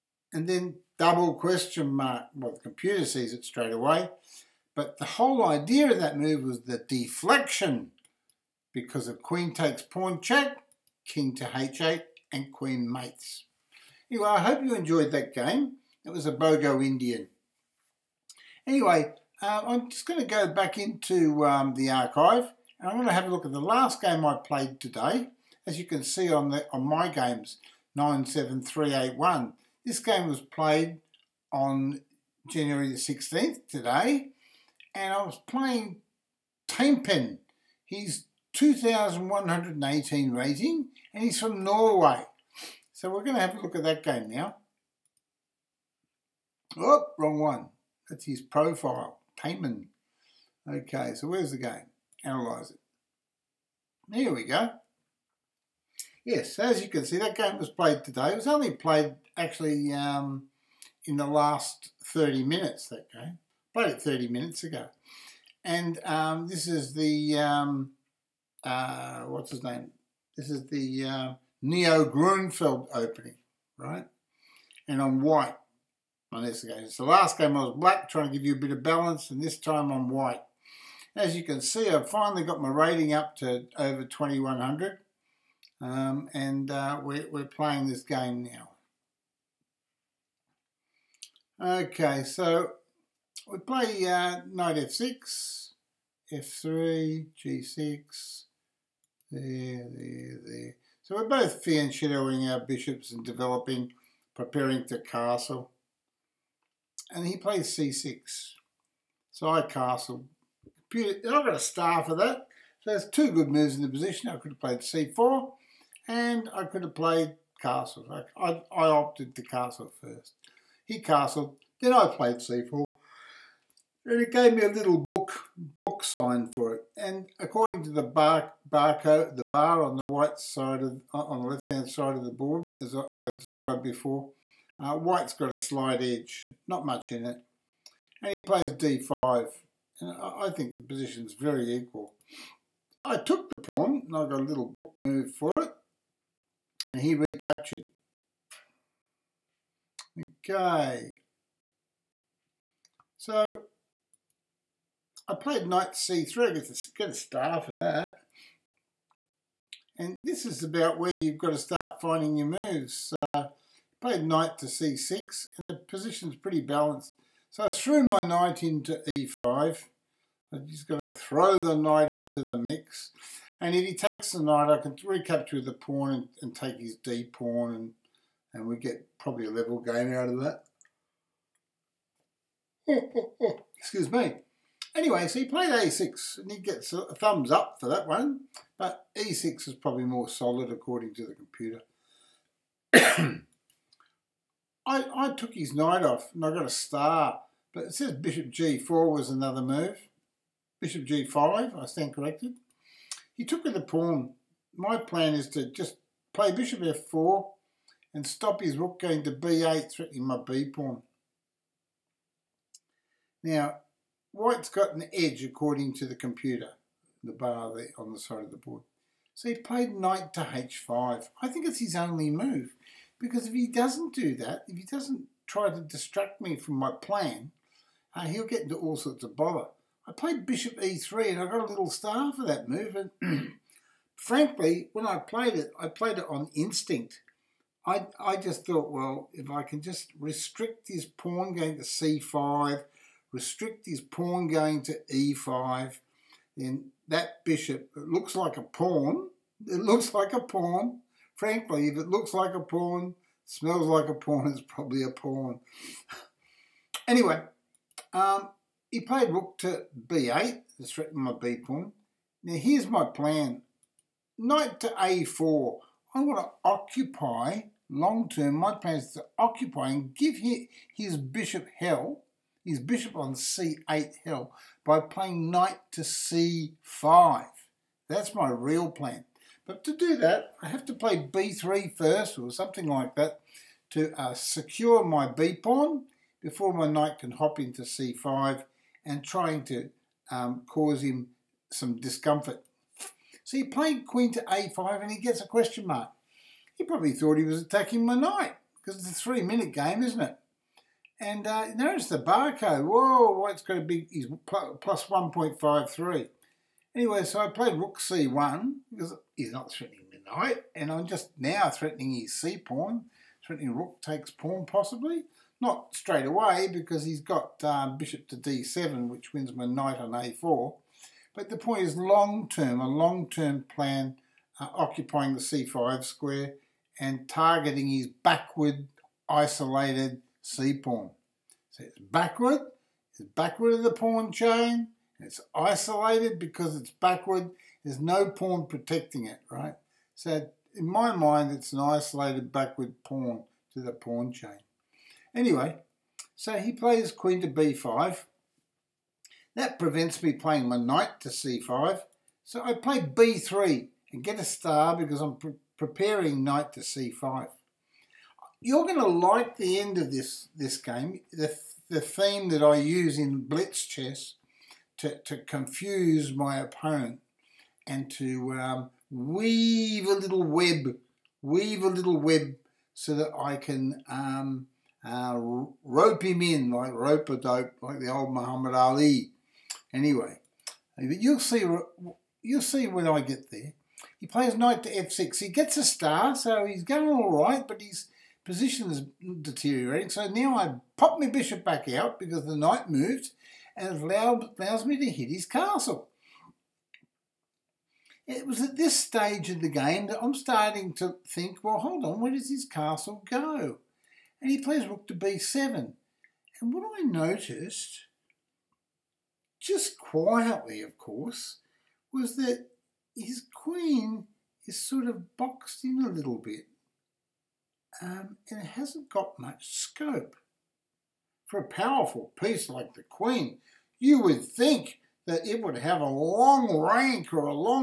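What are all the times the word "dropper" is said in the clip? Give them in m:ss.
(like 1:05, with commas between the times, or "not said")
not said.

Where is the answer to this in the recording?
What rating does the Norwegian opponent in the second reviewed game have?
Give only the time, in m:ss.
0:38.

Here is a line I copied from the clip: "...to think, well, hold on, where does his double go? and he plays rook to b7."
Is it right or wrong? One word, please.
wrong.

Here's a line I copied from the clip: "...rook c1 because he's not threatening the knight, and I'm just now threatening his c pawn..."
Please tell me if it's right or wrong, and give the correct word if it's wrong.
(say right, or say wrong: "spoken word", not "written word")
right.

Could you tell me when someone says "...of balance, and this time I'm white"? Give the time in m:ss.
1:18.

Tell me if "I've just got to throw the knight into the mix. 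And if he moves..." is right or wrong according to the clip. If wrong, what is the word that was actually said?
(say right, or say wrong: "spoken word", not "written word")
wrong: "takes", not "moves".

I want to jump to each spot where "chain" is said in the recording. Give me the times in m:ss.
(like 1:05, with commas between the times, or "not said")
5:34, 5:44.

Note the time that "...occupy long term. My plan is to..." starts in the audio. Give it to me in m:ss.
4:26.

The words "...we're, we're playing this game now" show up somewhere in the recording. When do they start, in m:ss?
1:27.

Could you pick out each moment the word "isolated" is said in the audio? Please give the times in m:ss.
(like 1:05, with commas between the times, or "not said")
5:29, 5:35, 5:41.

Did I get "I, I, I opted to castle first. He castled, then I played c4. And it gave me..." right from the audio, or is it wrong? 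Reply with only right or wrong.
right.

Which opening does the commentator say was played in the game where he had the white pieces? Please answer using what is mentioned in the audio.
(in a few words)
Neo Grunfeld.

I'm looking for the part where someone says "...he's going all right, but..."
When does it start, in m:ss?
6:26.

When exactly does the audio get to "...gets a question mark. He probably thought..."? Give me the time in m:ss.
4:55.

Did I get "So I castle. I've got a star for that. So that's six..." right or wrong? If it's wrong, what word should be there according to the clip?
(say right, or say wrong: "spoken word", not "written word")
wrong: "two", not "six".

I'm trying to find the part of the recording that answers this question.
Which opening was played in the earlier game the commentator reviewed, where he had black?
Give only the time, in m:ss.
0:16.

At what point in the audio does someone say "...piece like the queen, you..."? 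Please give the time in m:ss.
7:02.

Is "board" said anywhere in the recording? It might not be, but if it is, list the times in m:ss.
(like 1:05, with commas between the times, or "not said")
2:12, 3:38.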